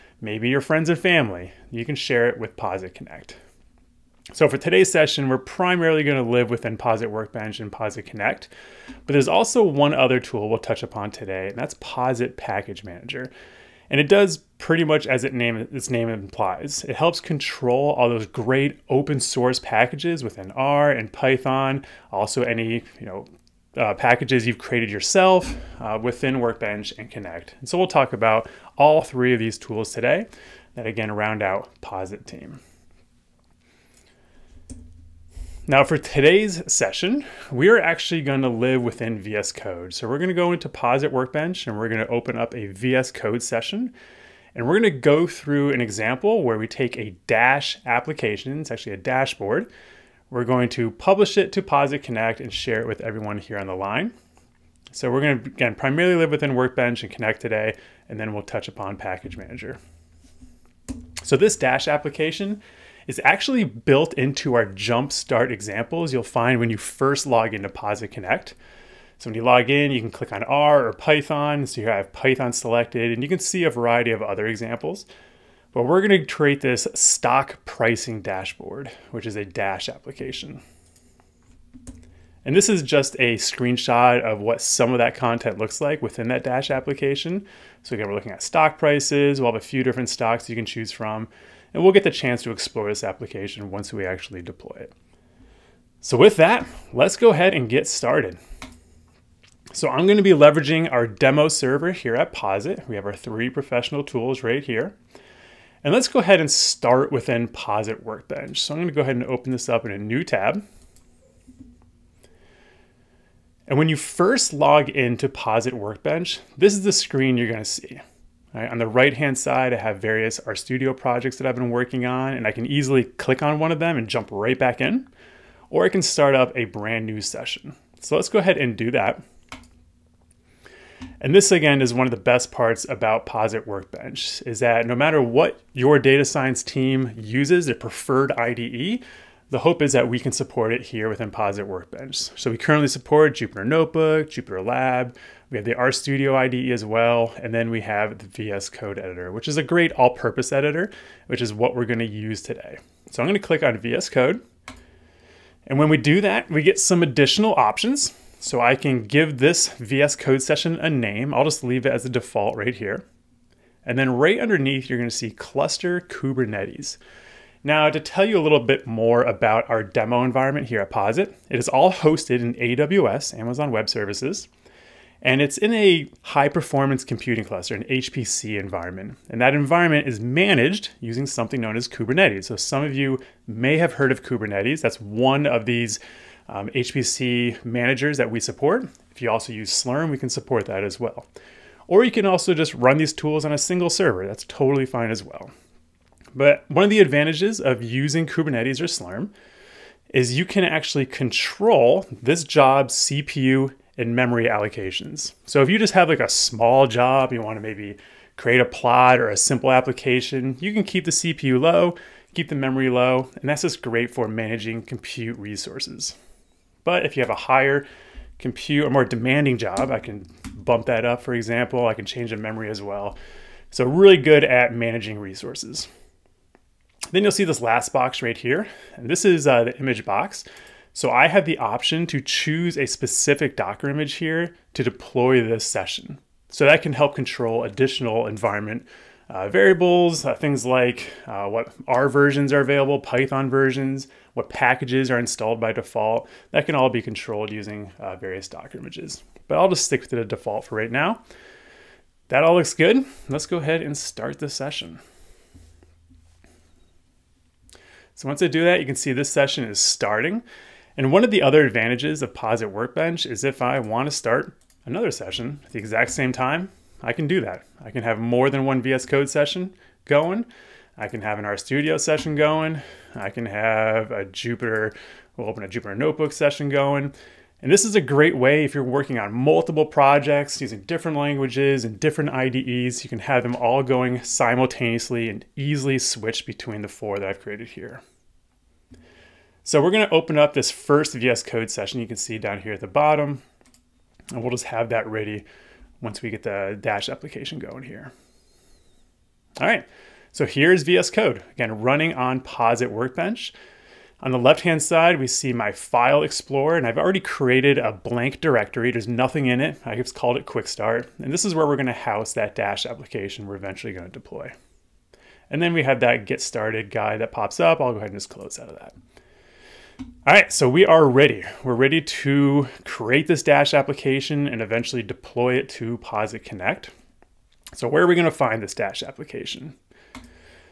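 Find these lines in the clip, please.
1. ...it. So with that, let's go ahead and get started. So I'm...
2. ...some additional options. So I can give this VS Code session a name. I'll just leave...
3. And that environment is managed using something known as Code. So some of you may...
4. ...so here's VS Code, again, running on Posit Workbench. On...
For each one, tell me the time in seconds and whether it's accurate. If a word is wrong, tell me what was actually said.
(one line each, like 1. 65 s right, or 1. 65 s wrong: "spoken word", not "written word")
1. 94 s right
2. 156 s right
3. 179 s wrong: "Kubernetes", not "Code"
4. 300 s right.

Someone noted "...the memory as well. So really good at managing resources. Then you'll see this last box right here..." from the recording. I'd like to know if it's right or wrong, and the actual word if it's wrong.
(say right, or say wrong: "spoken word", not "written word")
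right.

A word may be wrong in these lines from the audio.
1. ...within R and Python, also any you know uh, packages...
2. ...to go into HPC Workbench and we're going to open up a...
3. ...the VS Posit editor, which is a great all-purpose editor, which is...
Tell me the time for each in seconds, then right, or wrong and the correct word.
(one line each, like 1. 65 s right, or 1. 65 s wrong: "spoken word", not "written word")
1. 20 s right
2. 40 s wrong: "Posit", not "HPC"
3. 148 s wrong: "Code", not "Posit".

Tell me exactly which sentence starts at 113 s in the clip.
And when you first log into Posit Workbench, this is the screen you're gonna see.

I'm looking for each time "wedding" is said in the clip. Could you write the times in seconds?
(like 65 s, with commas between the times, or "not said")
not said.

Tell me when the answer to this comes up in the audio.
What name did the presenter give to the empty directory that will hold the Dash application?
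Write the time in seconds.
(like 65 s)
310 s.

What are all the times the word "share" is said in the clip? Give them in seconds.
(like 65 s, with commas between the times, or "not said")
1 s, 52 s.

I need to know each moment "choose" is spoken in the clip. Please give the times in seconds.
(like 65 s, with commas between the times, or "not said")
90 s, 232 s.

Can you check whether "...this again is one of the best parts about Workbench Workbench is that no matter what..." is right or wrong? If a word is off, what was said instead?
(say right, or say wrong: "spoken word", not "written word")
wrong: "Posit", not "Workbench".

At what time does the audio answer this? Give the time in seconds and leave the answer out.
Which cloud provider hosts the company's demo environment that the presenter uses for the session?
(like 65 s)
173 s.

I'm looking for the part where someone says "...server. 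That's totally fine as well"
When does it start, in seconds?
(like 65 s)
193 s.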